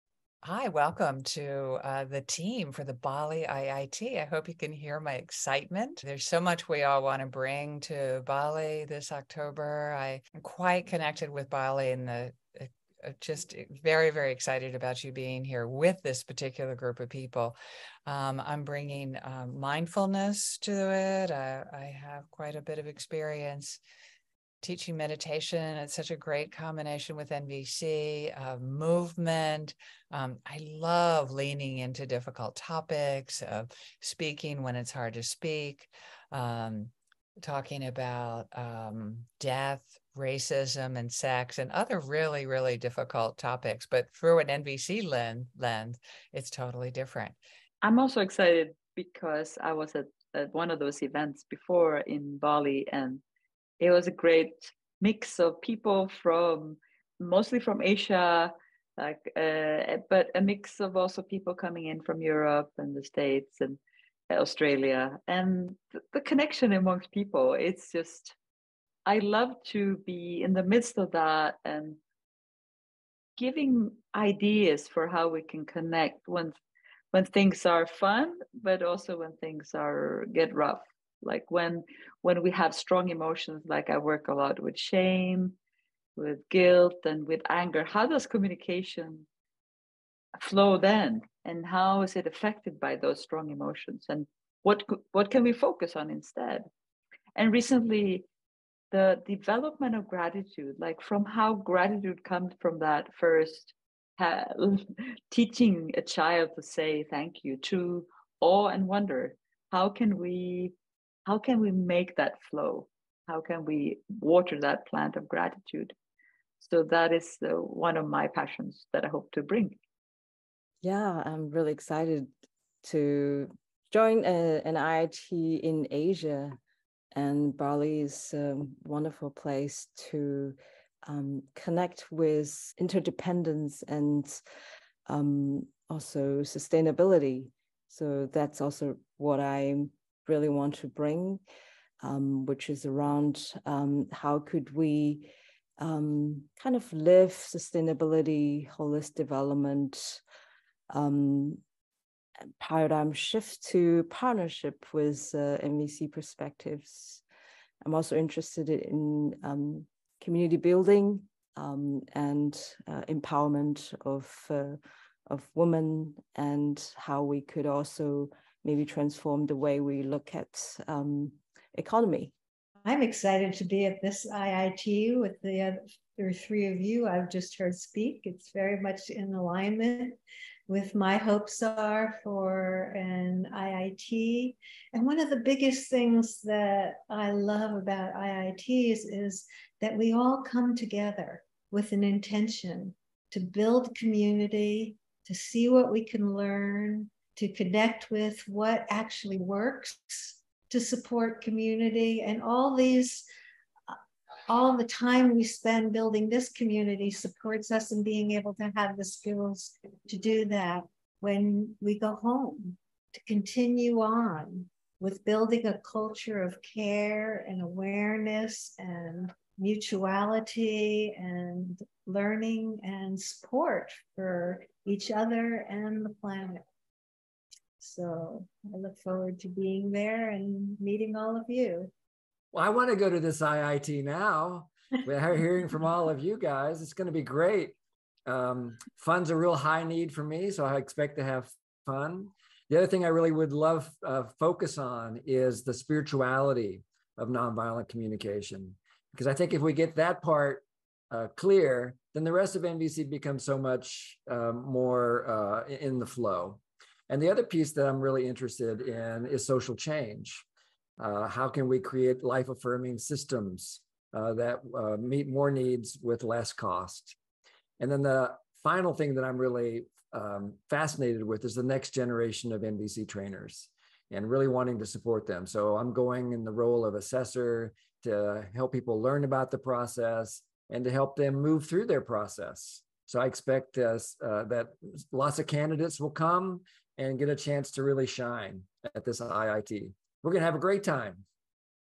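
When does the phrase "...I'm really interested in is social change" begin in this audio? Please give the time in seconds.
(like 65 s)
257 s.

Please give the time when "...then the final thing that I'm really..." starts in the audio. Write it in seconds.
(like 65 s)
267 s.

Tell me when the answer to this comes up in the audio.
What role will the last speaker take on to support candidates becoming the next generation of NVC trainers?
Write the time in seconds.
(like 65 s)
276 s.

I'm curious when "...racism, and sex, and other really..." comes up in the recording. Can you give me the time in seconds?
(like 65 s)
40 s.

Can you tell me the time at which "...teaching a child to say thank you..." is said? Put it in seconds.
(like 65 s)
105 s.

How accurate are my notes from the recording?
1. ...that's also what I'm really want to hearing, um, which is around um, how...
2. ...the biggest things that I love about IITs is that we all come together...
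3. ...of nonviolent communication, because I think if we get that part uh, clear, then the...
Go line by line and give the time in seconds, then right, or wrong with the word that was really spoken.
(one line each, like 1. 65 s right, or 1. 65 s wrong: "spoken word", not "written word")
1. 138 s wrong: "bring", not "hearing"
2. 185 s right
3. 247 s right.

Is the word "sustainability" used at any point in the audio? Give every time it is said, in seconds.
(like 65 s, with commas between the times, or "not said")
136 s, 147 s.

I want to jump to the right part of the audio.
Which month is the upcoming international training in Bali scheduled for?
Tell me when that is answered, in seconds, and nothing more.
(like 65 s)
9 s.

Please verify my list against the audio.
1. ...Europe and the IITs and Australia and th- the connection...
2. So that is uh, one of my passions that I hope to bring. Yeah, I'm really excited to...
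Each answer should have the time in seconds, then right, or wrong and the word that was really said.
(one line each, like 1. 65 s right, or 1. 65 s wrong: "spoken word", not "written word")
1. 62 s wrong: "States", not "IITs"
2. 116 s right.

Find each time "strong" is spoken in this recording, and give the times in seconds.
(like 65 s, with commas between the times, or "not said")
82 s, 93 s.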